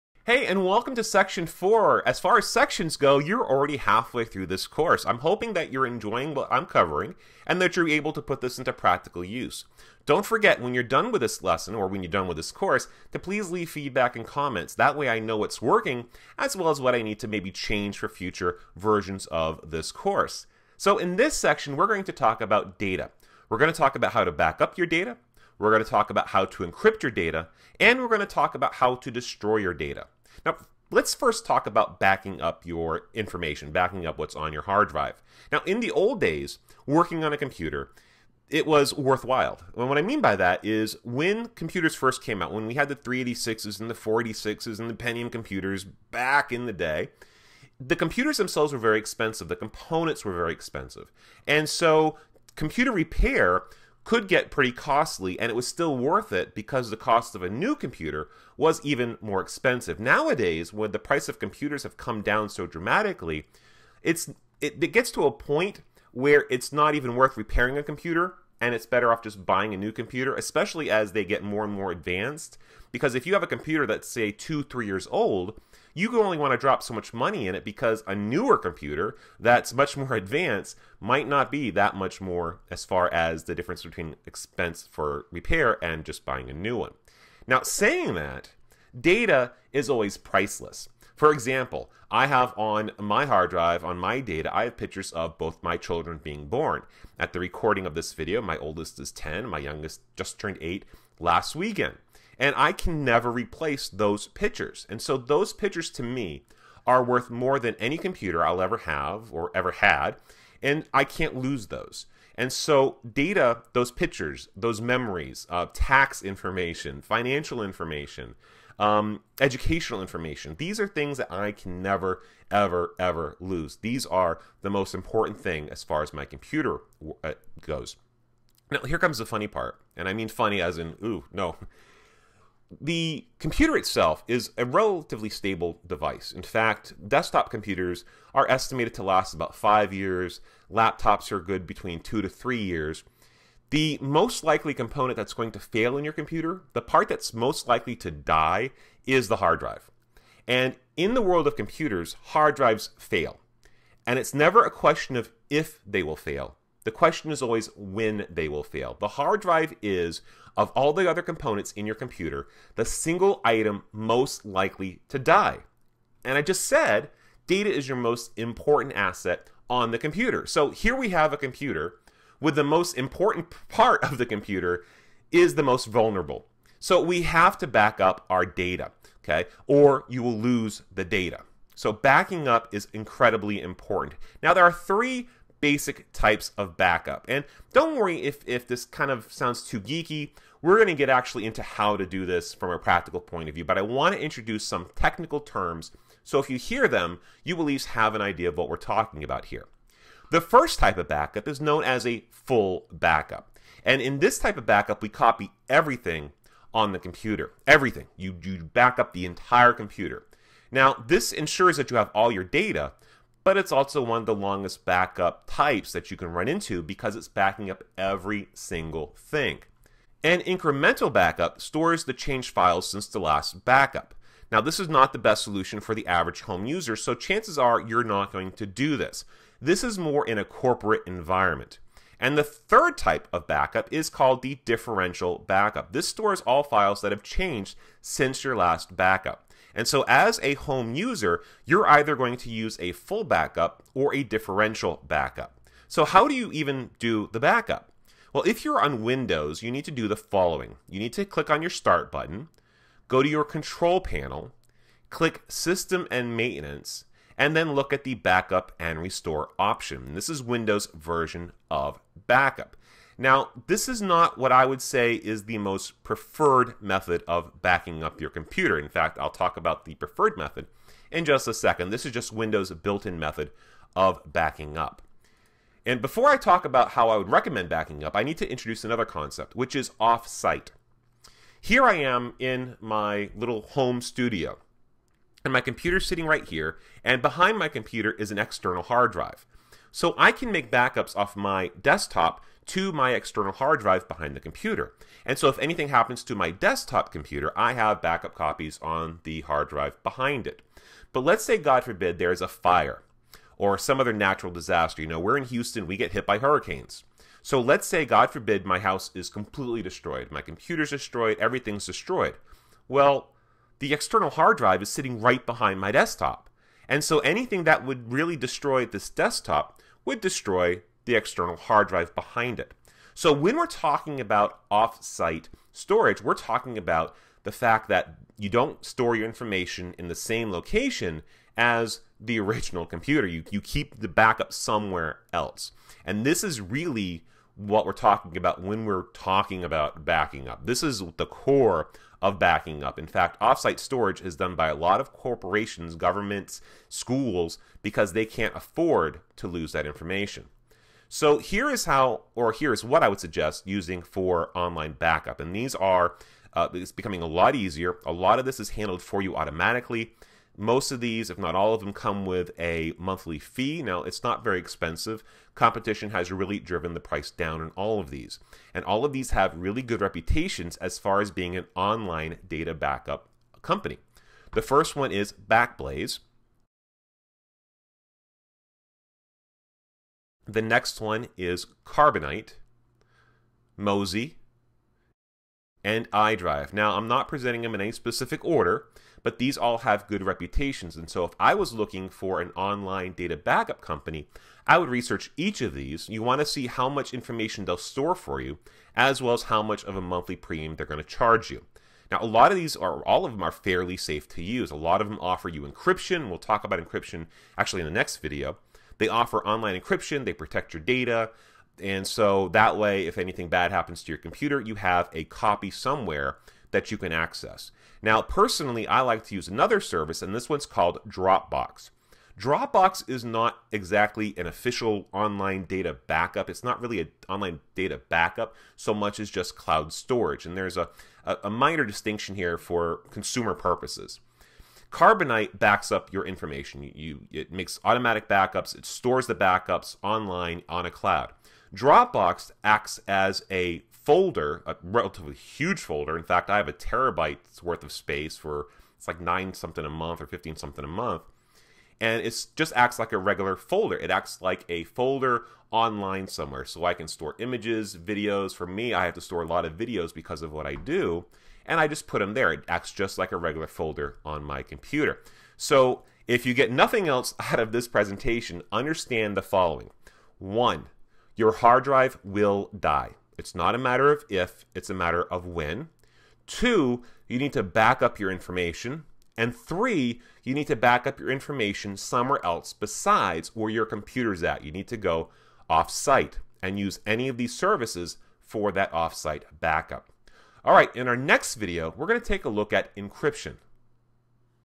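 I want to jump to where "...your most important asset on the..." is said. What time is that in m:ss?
2:47.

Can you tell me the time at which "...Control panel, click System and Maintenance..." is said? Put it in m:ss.
4:13.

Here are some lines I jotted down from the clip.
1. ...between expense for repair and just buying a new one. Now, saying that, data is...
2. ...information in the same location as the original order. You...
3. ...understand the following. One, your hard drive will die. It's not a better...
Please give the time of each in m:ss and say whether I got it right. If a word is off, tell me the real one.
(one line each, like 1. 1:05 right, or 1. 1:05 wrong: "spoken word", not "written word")
1. 1:23 right
2. 5:29 wrong: "computer", not "order"
3. 7:48 wrong: "matter", not "better".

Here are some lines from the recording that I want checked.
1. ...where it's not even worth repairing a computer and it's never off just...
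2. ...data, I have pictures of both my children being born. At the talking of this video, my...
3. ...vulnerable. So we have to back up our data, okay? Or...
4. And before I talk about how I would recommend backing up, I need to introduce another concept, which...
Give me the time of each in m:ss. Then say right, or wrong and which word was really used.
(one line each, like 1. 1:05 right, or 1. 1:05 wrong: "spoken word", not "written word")
1. 1:06 wrong: "better", not "never"
2. 1:34 wrong: "recording", not "talking"
3. 2:55 right
4. 4:35 right.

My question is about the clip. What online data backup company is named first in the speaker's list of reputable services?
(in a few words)
Backblaze.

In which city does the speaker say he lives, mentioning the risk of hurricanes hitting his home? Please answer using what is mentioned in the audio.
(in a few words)
Houston.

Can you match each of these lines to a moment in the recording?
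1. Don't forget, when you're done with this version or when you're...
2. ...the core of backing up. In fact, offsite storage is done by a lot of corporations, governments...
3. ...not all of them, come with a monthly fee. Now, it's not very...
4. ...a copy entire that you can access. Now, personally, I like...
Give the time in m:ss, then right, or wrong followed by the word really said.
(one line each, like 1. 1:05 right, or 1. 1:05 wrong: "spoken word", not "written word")
1. 0:10 wrong: "lesson", not "version"
2. 5:41 right
3. 6:01 right
4. 6:55 wrong: "somewhere", not "entire".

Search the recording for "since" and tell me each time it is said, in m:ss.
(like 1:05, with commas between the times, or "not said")
3:42, 3:58.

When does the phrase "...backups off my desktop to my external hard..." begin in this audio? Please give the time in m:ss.
4:50.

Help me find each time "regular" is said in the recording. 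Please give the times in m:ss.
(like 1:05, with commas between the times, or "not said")
7:33, 7:43.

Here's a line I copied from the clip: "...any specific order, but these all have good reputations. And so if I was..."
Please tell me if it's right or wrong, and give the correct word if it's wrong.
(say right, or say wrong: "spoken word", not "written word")
right.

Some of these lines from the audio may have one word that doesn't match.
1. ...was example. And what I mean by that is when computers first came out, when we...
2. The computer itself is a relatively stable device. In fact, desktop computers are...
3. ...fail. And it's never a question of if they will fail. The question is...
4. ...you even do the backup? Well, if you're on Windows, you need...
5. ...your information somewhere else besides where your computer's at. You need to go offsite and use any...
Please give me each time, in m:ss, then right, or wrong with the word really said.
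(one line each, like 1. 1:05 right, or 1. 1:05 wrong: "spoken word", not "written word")
1. 0:38 wrong: "worthwhile", not "example"
2. 2:12 right
3. 2:32 right
4. 4:06 right
5. 8:01 right.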